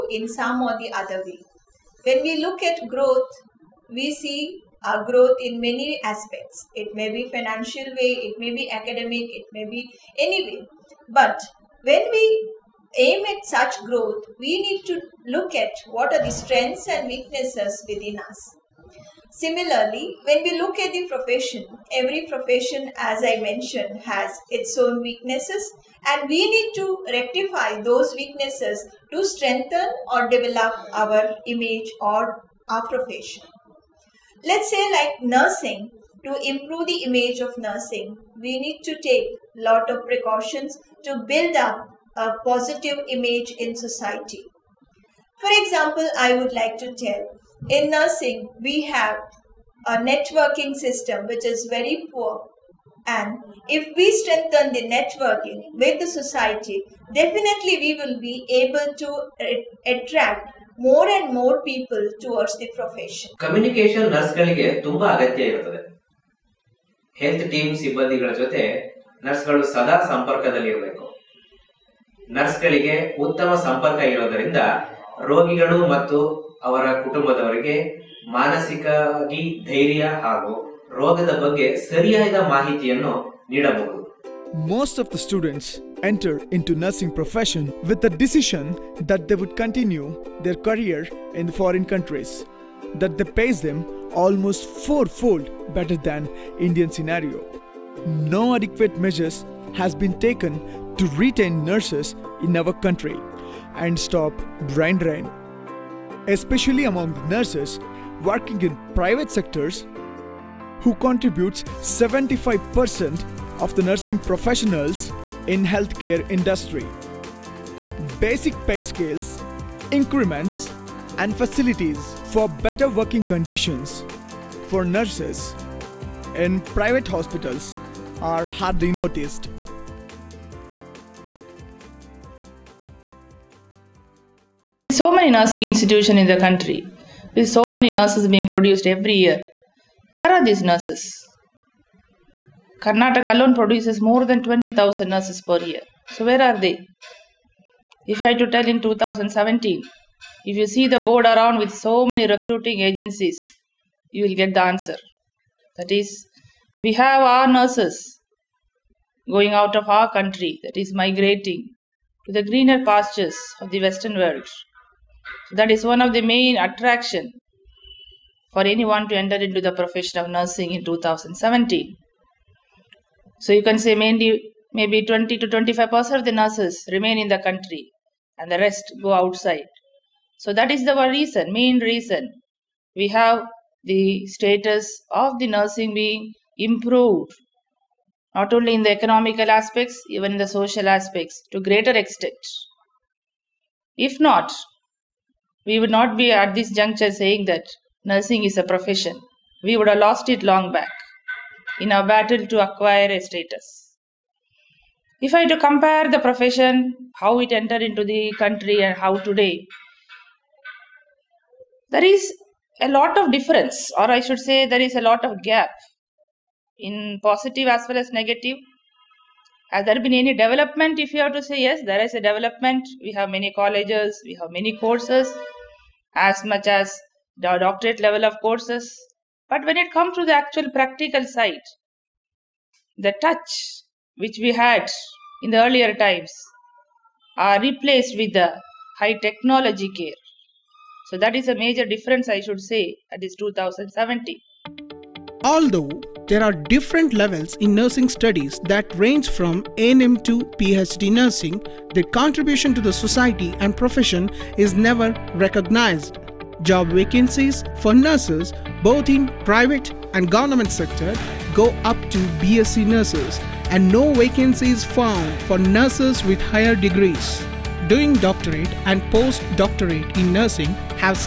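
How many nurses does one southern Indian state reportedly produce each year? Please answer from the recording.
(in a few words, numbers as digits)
more than 20,000.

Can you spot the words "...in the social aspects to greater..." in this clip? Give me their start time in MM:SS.
03:10.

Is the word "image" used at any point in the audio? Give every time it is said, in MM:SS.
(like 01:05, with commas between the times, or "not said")
00:31, 00:37, 00:43.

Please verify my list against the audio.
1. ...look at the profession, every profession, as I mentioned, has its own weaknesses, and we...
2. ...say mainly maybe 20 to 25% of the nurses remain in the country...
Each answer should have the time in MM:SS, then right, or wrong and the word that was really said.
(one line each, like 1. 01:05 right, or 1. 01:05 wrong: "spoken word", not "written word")
1. 00:20 right
2. 02:53 right.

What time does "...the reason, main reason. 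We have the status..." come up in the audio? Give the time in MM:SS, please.
03:00.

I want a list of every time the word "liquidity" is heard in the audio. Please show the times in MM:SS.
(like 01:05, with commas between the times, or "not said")
not said.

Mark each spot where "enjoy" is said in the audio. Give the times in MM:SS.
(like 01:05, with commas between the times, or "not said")
not said.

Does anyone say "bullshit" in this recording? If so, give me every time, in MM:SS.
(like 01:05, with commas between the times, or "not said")
not said.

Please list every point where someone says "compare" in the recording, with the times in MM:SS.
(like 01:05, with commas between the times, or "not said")
03:25.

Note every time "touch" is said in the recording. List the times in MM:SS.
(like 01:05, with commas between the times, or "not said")
03:53.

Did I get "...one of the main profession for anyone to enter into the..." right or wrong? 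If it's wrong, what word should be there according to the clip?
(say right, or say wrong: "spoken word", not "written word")
wrong: "attraction", not "profession".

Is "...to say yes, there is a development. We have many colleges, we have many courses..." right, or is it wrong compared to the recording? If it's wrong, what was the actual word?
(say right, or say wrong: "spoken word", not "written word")
right.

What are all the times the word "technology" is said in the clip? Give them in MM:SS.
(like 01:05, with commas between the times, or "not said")
03:59.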